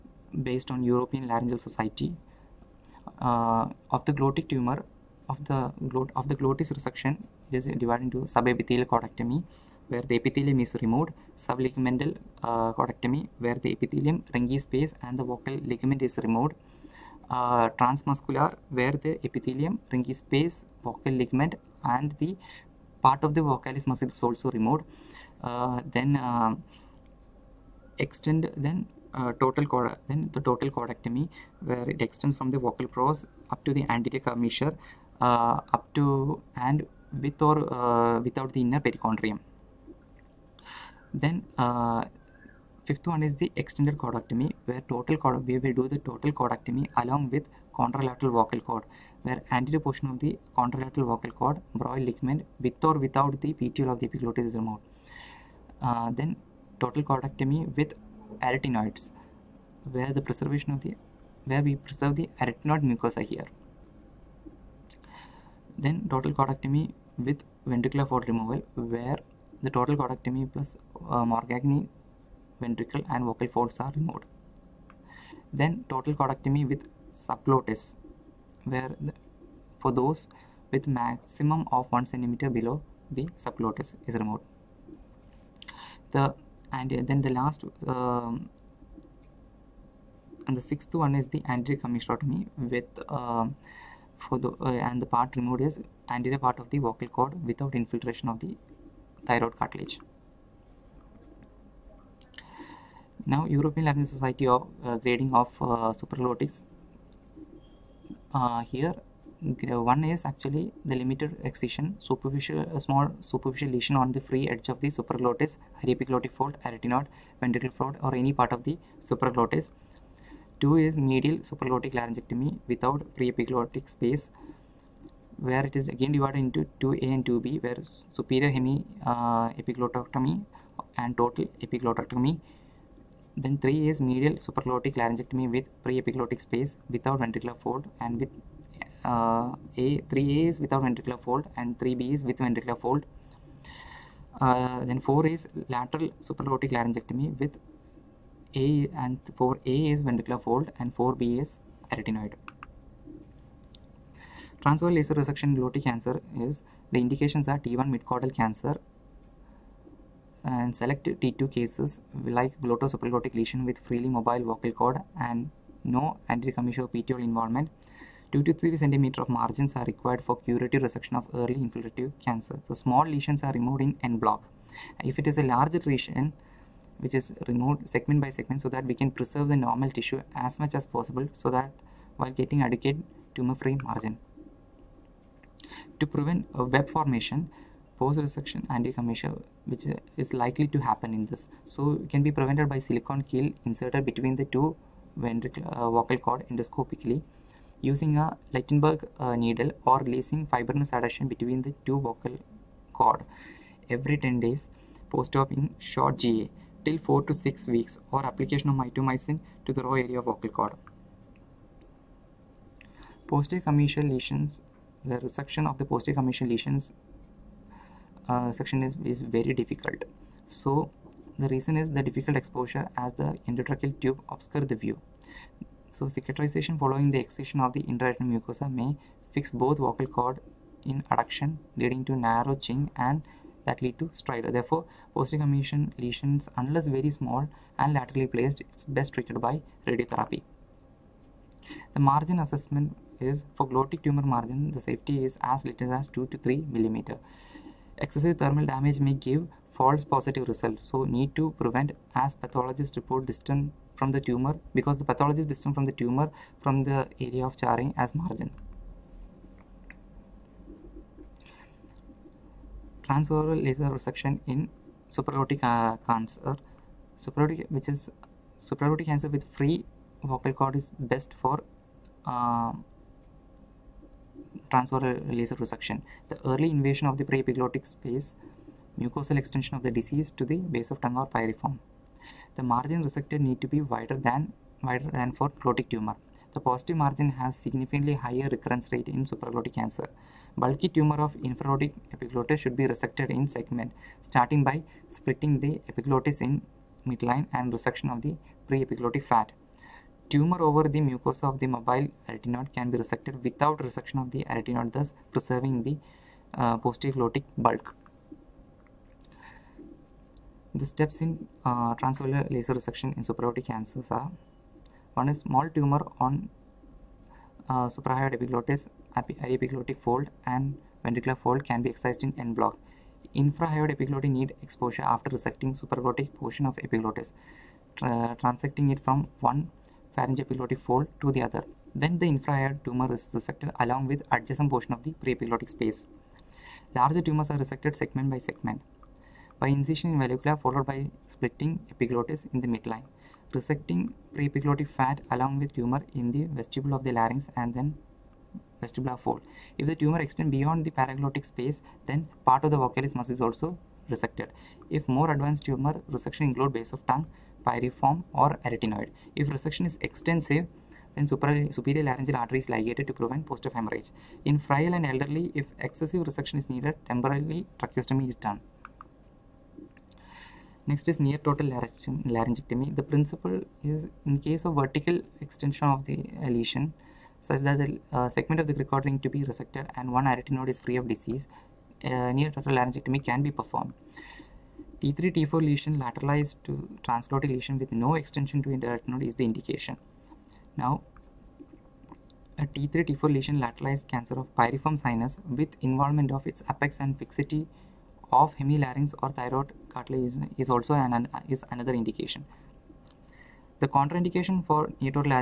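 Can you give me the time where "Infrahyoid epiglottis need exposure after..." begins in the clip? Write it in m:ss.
5:23.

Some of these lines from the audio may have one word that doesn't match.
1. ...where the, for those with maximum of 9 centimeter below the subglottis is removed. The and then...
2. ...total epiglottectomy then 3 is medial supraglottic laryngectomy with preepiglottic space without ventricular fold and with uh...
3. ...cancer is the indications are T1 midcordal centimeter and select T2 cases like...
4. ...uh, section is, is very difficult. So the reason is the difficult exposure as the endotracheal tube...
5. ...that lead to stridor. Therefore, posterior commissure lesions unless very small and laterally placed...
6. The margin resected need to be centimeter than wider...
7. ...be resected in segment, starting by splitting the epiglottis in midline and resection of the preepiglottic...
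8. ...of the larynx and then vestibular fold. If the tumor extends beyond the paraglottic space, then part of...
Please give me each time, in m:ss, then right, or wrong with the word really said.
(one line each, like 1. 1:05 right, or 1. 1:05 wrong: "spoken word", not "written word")
1. 1:18 wrong: "1", not "9"
2. 2:11 right
3. 2:35 wrong: "cancer", not "centimeter"
4. 3:38 right
5. 3:53 right
6. 4:42 wrong: "wider", not "centimeter"
7. 4:52 right
8. 5:46 right.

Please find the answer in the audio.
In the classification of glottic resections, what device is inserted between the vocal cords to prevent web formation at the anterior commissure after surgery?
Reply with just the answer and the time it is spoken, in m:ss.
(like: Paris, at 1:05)
Silicone keel, at 3:12.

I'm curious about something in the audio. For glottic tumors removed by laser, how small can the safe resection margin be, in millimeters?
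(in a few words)
2 to 3 mm.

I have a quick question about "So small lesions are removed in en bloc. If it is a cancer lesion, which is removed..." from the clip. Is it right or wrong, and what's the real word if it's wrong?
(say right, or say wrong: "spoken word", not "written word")
wrong: "larger", not "cancer".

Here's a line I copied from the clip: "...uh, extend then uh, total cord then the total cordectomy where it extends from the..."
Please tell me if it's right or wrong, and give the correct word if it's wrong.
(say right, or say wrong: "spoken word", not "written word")
right.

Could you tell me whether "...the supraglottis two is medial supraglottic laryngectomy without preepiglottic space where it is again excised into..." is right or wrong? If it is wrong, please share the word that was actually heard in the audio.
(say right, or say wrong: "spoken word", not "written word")
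wrong: "divided", not "excised".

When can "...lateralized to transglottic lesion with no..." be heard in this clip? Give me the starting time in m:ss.
6:25.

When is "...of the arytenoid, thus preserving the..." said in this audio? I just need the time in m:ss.
5:04.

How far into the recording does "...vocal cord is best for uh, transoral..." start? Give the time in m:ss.
4:30.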